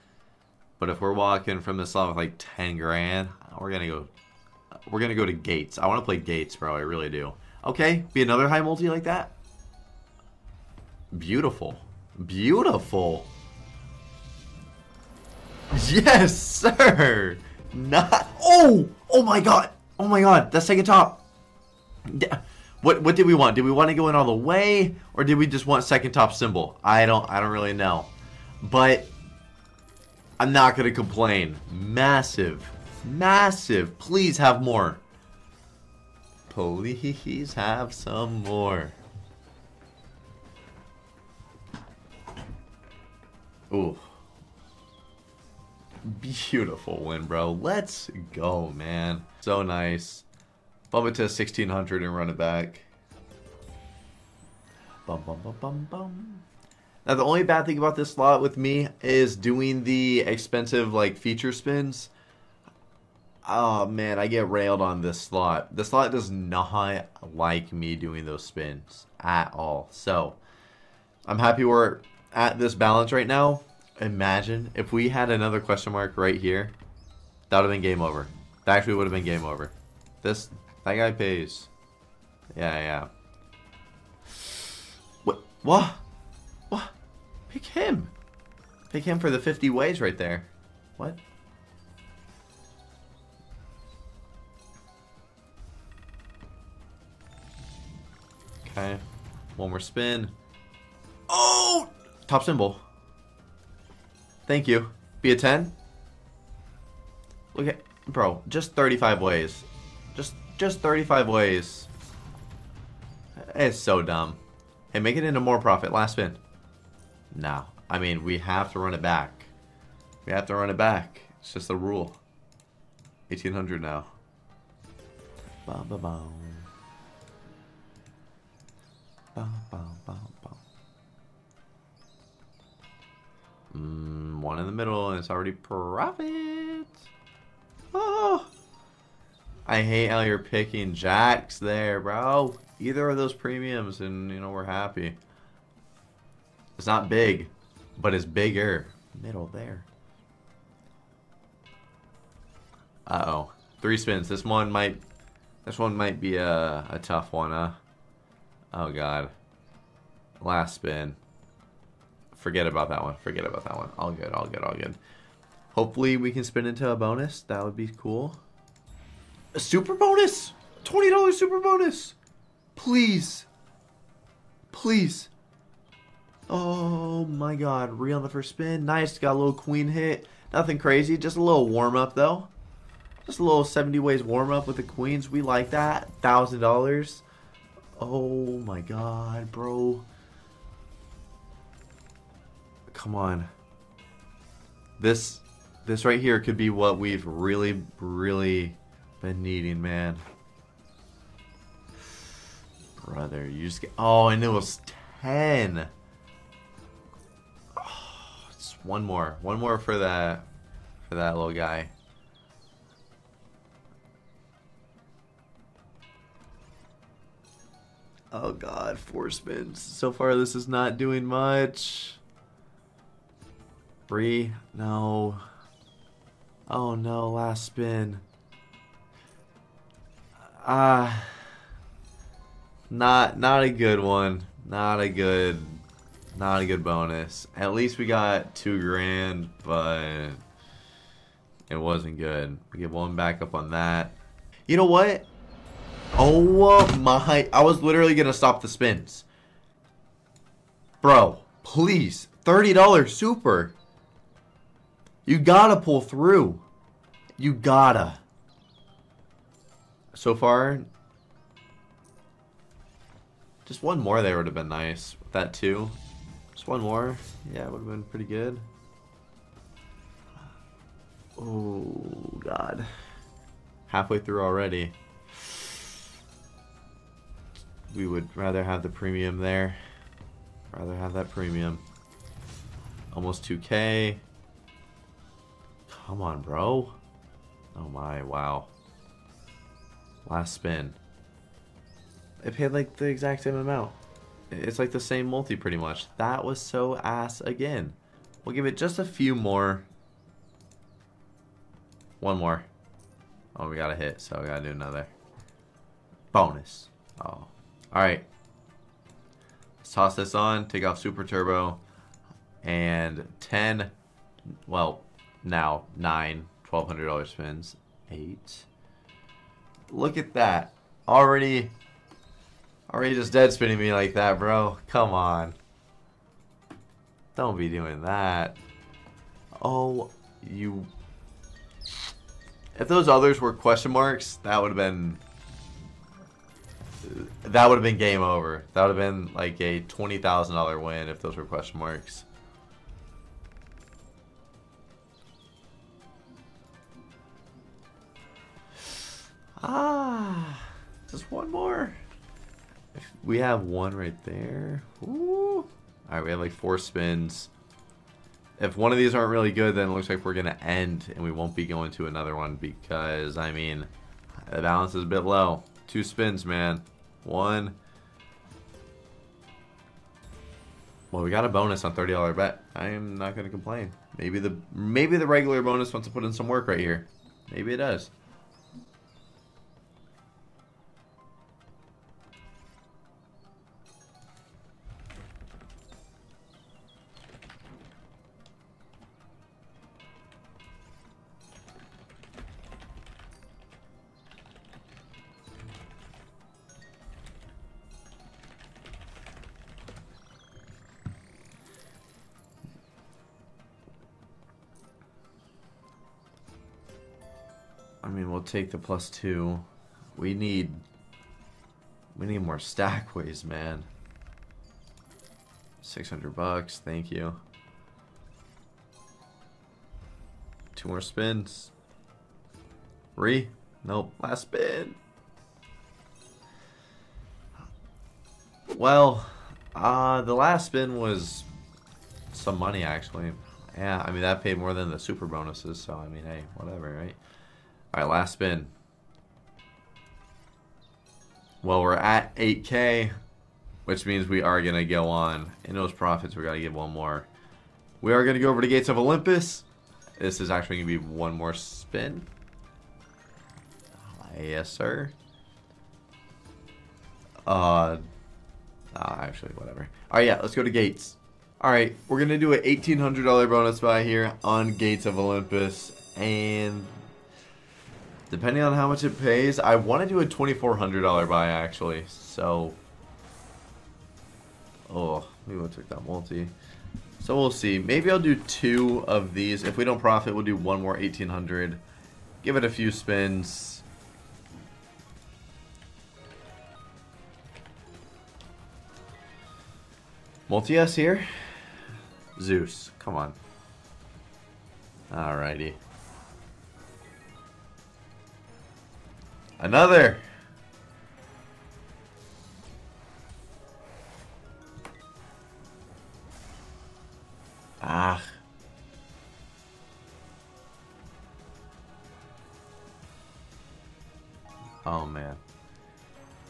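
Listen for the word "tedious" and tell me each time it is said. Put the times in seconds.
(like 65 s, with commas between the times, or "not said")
not said.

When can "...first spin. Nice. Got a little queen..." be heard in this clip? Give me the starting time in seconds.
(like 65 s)
178 s.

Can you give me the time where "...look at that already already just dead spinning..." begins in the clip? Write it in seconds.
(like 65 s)
319 s.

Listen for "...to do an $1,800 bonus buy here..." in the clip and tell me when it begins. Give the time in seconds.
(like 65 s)
462 s.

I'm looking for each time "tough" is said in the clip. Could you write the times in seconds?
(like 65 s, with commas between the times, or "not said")
157 s.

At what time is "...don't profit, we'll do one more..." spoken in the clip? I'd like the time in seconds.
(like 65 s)
479 s.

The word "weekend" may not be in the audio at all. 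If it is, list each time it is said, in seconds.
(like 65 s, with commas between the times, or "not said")
not said.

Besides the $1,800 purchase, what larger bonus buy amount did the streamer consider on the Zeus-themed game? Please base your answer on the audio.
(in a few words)
$2,400.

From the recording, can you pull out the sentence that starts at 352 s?
If we have one right there.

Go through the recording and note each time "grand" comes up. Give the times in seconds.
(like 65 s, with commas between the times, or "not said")
2 s, 238 s.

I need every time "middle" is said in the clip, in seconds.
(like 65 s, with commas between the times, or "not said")
134 s, 149 s.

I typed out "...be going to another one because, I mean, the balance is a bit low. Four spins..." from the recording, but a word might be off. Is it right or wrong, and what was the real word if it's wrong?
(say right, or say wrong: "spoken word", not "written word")
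wrong: "Two", not "Four".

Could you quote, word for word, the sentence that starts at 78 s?
That actually would have been game over.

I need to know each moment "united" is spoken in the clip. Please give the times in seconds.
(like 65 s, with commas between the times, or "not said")
not said.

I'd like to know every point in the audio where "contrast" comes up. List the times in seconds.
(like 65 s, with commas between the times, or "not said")
not said.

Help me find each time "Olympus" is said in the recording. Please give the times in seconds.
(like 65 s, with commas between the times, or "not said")
448 s, 465 s.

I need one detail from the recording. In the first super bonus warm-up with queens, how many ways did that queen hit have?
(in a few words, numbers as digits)
70 ways.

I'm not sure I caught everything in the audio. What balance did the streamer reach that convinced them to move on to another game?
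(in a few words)
8K.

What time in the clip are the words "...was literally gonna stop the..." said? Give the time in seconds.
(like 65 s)
247 s.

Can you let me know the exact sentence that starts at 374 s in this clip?
Maybe the maybe the regular bonus wants to put in some work right here.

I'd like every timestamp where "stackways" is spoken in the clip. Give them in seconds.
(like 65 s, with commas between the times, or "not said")
412 s.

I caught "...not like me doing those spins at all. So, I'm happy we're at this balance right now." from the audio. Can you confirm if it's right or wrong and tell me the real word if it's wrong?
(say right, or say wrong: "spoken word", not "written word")
right.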